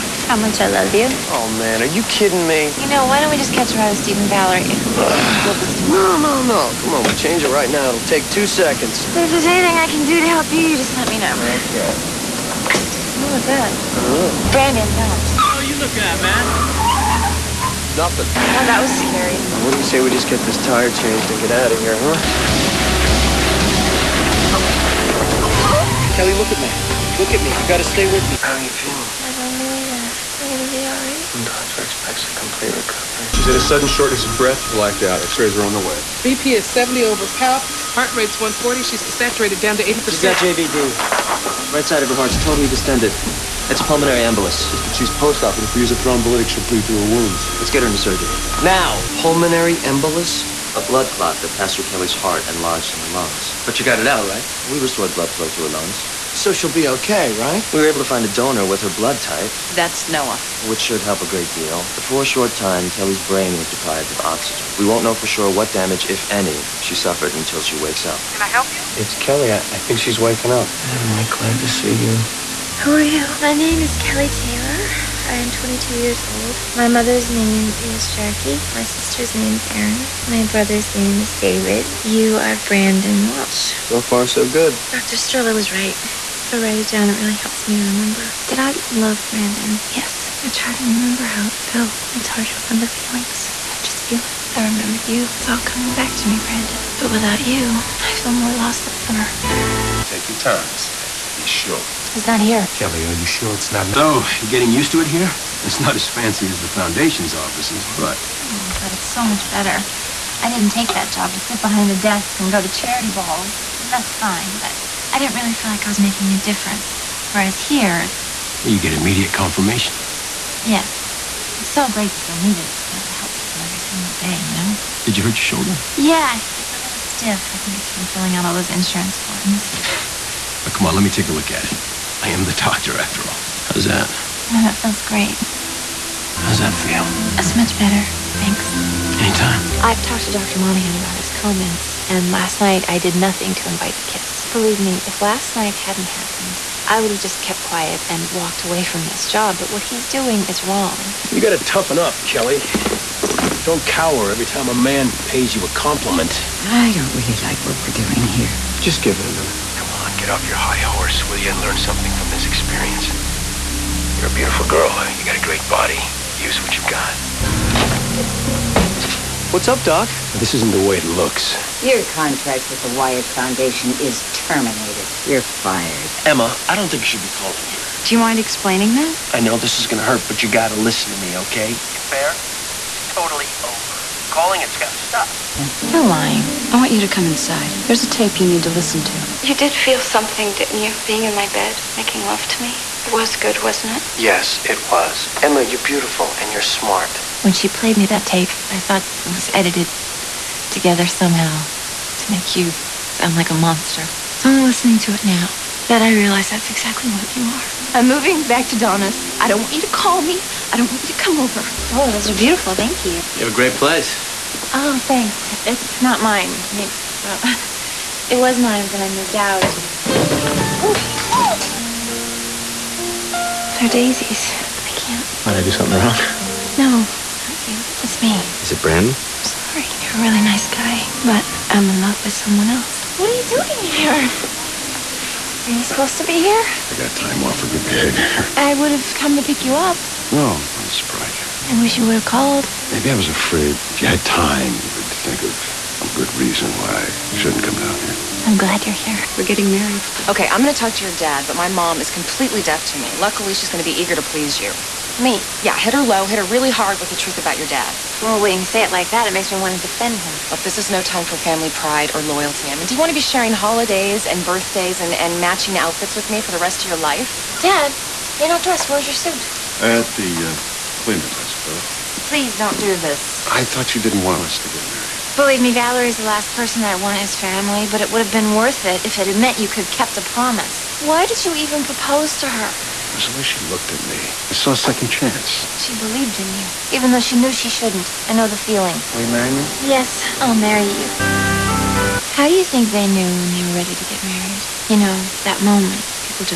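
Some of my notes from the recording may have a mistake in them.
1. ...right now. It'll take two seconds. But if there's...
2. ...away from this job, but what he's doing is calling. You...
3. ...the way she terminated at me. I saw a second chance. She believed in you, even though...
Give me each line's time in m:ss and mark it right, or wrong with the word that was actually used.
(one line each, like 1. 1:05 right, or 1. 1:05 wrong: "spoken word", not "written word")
1. 0:07 right
2. 2:28 wrong: "wrong", not "calling"
3. 4:43 wrong: "looked", not "terminated".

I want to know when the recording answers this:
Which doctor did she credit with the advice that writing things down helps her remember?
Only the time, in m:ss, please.
1:24.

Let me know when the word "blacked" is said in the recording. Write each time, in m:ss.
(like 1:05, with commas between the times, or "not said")
0:34.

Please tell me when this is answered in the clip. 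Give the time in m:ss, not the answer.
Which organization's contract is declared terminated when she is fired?
2:52.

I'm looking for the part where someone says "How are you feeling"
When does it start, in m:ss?
0:28.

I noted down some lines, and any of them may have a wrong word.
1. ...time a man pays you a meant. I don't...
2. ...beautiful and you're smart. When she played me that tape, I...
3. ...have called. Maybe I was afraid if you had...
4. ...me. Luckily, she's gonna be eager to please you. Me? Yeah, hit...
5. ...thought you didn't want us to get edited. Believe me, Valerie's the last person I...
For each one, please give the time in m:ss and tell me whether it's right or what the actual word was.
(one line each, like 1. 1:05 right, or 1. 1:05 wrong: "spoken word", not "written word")
1. 2:34 wrong: "compliment", not "meant"
2. 3:15 right
3. 4:02 right
4. 4:12 right
5. 4:33 wrong: "married", not "edited".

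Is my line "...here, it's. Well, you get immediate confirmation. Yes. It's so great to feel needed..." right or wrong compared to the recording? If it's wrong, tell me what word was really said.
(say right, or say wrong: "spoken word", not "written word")
right.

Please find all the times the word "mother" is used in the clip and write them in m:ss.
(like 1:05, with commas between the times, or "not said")
1:16.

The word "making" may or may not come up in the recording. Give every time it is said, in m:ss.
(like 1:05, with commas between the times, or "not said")
1:55, 3:11.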